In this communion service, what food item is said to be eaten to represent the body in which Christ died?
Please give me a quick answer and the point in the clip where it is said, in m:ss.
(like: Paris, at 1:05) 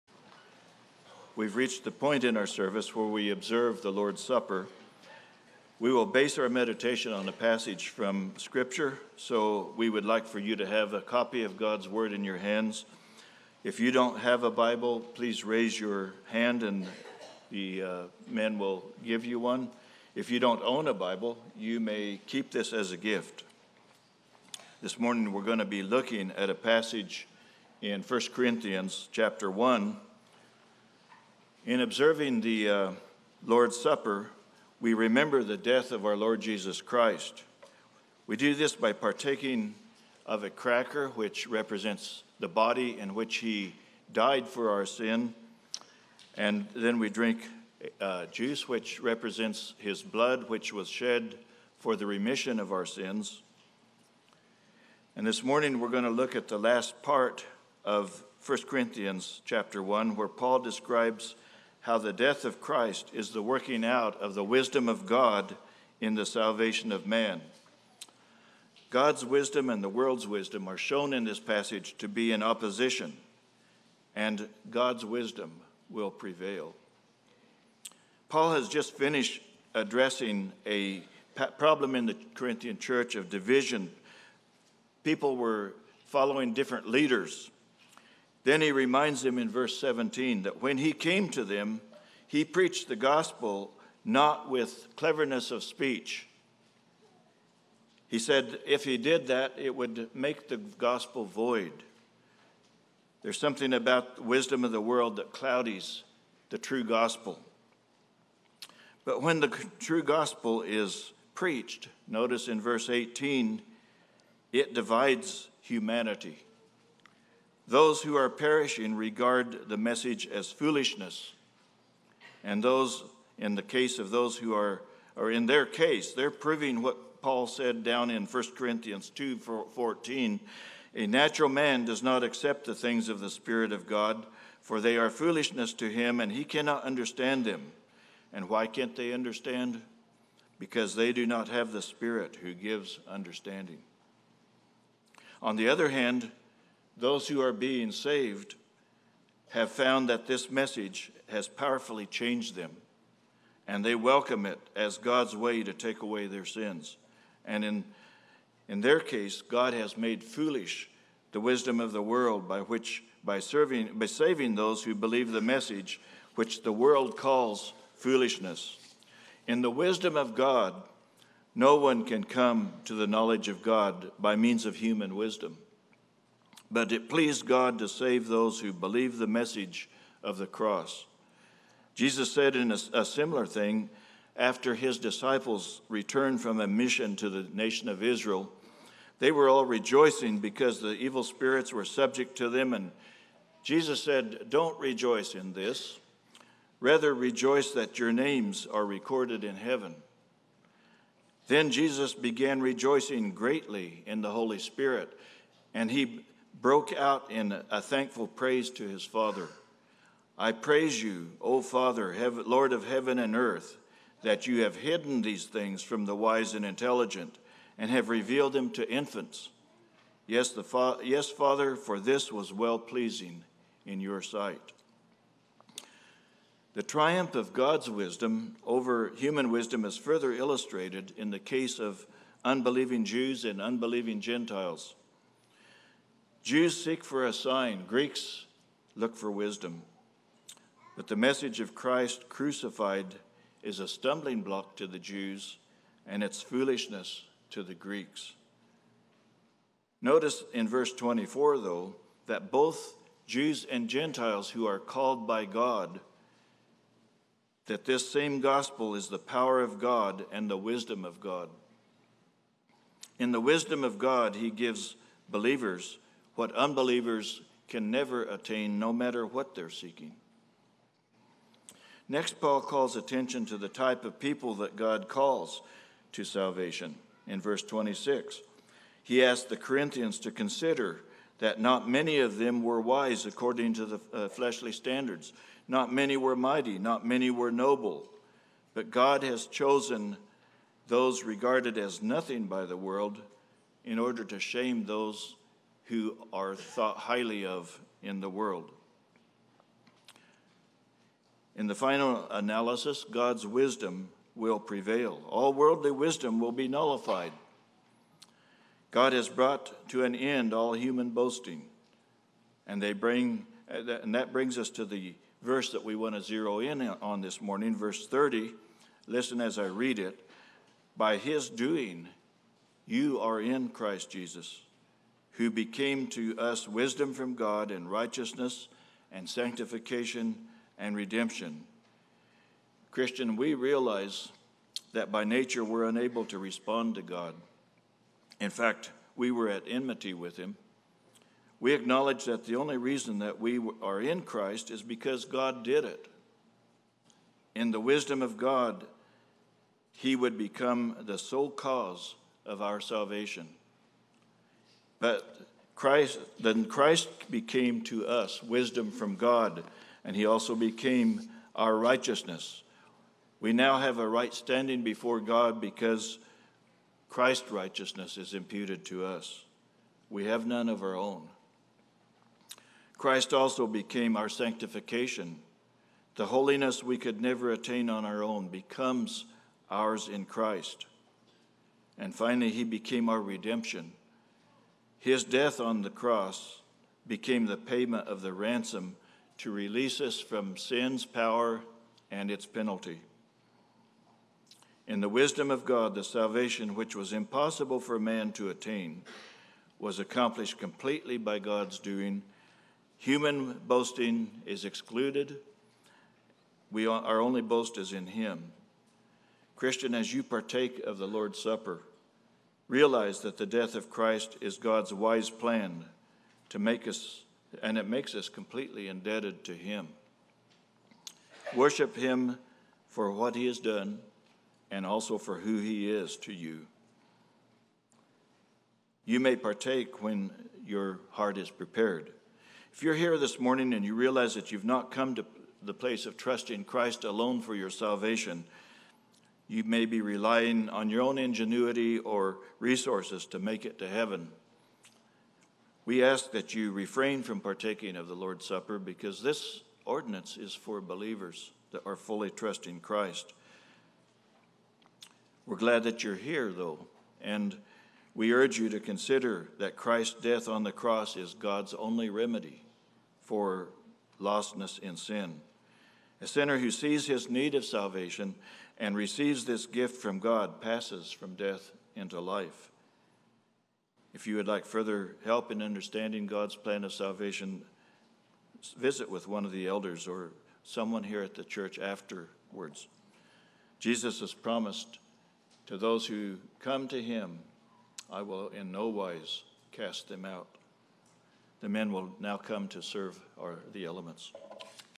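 A cracker, at 0:40.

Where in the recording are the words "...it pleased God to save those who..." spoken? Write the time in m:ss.
2:56.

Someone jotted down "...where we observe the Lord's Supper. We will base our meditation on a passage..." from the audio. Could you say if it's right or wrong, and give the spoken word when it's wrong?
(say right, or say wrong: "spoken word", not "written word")
right.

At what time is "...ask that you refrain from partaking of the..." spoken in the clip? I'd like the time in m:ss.
7:26.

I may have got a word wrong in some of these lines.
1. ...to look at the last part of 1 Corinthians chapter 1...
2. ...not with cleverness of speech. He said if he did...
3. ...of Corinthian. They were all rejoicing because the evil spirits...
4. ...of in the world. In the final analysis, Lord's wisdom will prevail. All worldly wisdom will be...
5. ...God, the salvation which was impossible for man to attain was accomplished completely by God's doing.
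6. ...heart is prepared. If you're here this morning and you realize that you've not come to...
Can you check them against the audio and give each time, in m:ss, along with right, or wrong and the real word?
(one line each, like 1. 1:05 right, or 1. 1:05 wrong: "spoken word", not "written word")
1. 0:56 right
2. 1:34 right
3. 3:07 wrong: "Israel", not "Corinthian"
4. 4:57 wrong: "God", not "Lord"
5. 6:35 right
6. 7:11 right.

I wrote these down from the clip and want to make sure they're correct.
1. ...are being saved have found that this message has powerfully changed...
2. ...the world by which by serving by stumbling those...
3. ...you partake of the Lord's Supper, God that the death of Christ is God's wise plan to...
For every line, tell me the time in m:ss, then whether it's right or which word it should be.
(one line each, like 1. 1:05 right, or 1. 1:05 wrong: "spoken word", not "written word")
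1. 2:27 right
2. 2:41 wrong: "saving", not "stumbling"
3. 6:50 wrong: "Realize", not "God".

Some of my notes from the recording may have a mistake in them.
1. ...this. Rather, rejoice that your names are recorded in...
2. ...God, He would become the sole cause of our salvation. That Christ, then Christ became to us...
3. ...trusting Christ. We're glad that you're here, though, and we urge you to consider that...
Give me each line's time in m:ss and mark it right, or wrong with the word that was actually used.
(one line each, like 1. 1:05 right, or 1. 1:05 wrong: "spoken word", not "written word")
1. 3:15 right
2. 5:48 right
3. 7:32 right.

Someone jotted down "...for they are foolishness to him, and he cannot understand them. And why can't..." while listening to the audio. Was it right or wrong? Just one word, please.
right.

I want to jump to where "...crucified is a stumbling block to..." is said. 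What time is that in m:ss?
4:02.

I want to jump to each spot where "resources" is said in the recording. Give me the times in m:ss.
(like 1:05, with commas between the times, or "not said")
7:22.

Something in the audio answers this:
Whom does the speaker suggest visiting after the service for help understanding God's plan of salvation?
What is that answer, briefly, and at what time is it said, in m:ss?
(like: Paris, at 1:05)
One of the elders, at 7:59.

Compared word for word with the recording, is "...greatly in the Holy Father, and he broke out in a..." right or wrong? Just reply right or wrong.
wrong.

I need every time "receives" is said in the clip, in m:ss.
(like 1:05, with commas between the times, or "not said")
7:48.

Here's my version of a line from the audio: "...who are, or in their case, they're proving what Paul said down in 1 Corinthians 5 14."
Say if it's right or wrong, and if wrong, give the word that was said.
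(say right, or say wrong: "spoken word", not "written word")
wrong: "2", not "5".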